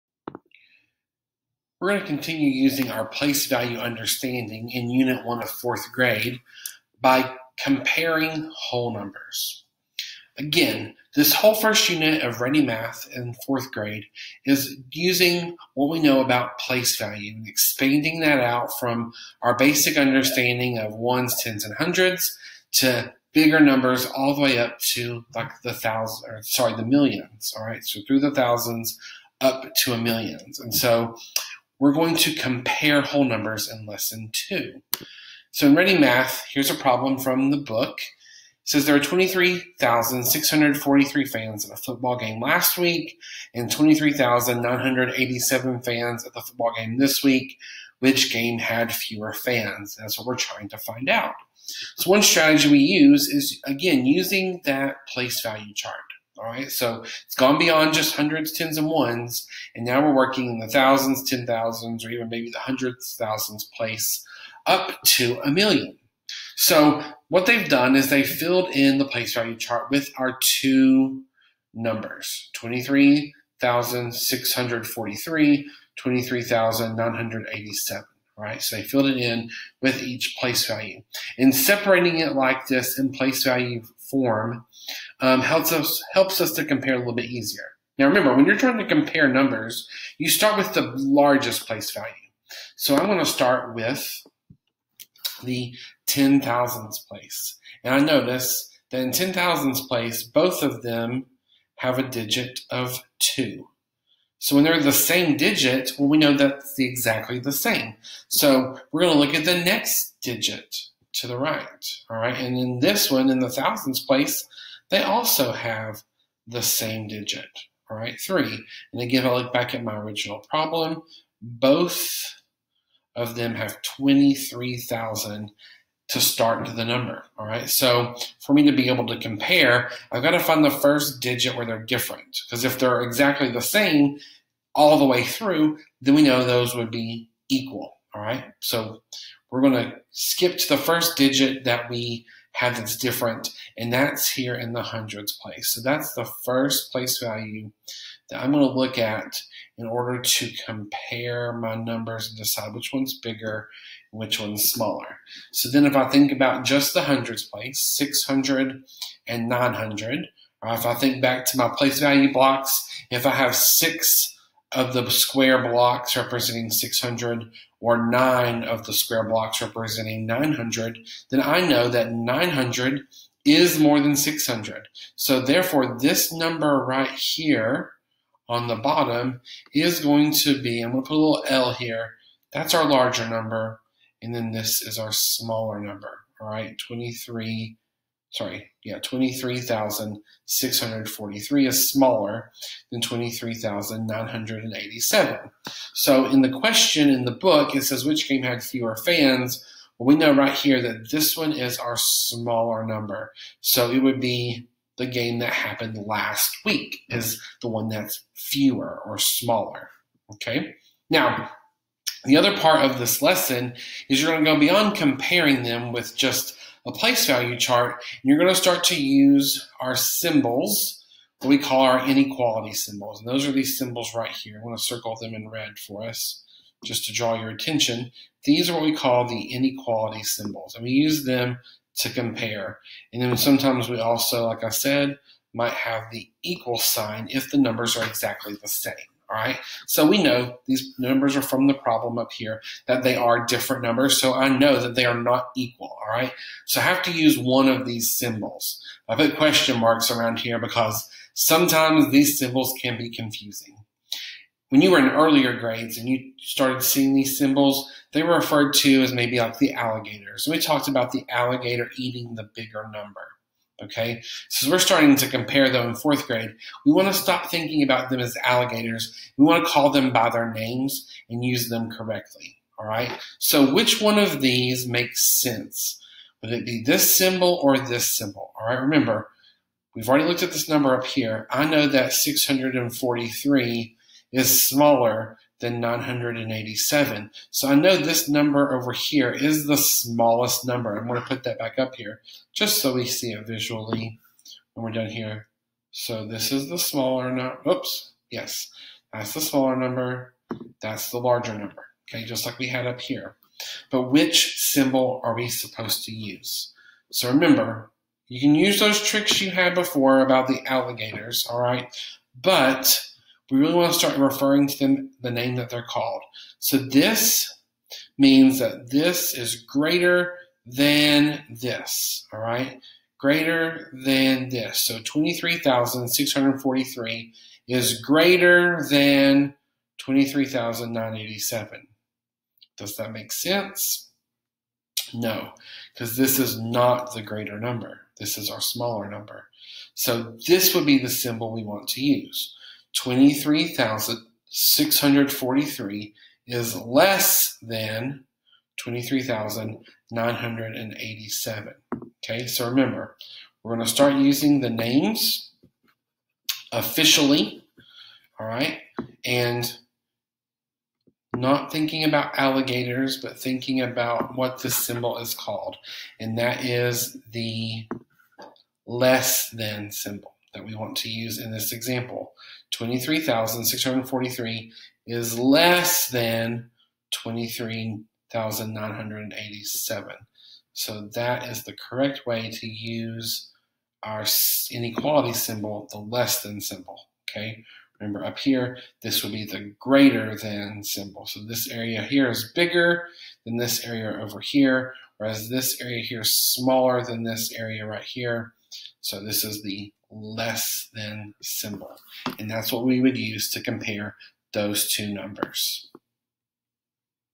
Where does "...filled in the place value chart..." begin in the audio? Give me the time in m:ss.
1:08.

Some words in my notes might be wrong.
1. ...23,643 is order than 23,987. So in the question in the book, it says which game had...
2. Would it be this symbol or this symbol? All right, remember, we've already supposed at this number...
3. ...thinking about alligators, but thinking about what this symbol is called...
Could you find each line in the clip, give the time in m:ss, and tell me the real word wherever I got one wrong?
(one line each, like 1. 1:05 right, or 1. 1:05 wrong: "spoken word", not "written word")
1. 3:08 wrong: "smaller", not "order"
2. 4:36 wrong: "looked", not "supposed"
3. 6:01 right.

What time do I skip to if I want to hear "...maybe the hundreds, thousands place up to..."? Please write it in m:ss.
1:02.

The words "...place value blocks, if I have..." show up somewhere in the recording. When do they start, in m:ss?
2:41.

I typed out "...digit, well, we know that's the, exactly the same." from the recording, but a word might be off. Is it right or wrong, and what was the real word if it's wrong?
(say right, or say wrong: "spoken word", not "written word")
right.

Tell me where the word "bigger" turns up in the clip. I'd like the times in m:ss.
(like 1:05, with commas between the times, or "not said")
0:23, 2:33, 4:22, 6:32.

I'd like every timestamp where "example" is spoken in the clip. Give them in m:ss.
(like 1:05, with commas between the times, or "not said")
6:11.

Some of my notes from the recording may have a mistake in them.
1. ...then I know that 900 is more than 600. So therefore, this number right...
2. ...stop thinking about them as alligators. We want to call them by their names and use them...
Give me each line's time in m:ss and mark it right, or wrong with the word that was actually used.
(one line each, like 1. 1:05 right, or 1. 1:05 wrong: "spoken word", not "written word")
1. 2:51 right
2. 4:27 right.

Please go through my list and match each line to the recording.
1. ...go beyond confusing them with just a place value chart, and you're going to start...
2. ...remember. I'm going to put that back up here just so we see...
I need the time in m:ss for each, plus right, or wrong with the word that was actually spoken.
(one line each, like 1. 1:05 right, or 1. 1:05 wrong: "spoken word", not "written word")
1. 3:34 wrong: "comparing", not "confusing"
2. 4:50 wrong: "number", not "remember".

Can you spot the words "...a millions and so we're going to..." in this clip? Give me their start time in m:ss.
0:29.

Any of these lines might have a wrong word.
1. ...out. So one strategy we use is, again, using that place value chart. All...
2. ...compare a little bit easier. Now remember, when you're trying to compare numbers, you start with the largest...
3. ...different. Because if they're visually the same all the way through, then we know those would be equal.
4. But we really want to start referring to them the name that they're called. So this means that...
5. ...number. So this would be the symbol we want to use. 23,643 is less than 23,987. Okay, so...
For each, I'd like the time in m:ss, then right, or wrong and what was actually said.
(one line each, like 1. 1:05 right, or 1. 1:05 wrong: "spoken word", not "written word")
1. 0:51 right
2. 1:26 right
3. 2:11 wrong: "exactly", not "visually"
4. 5:12 right
5. 5:39 right.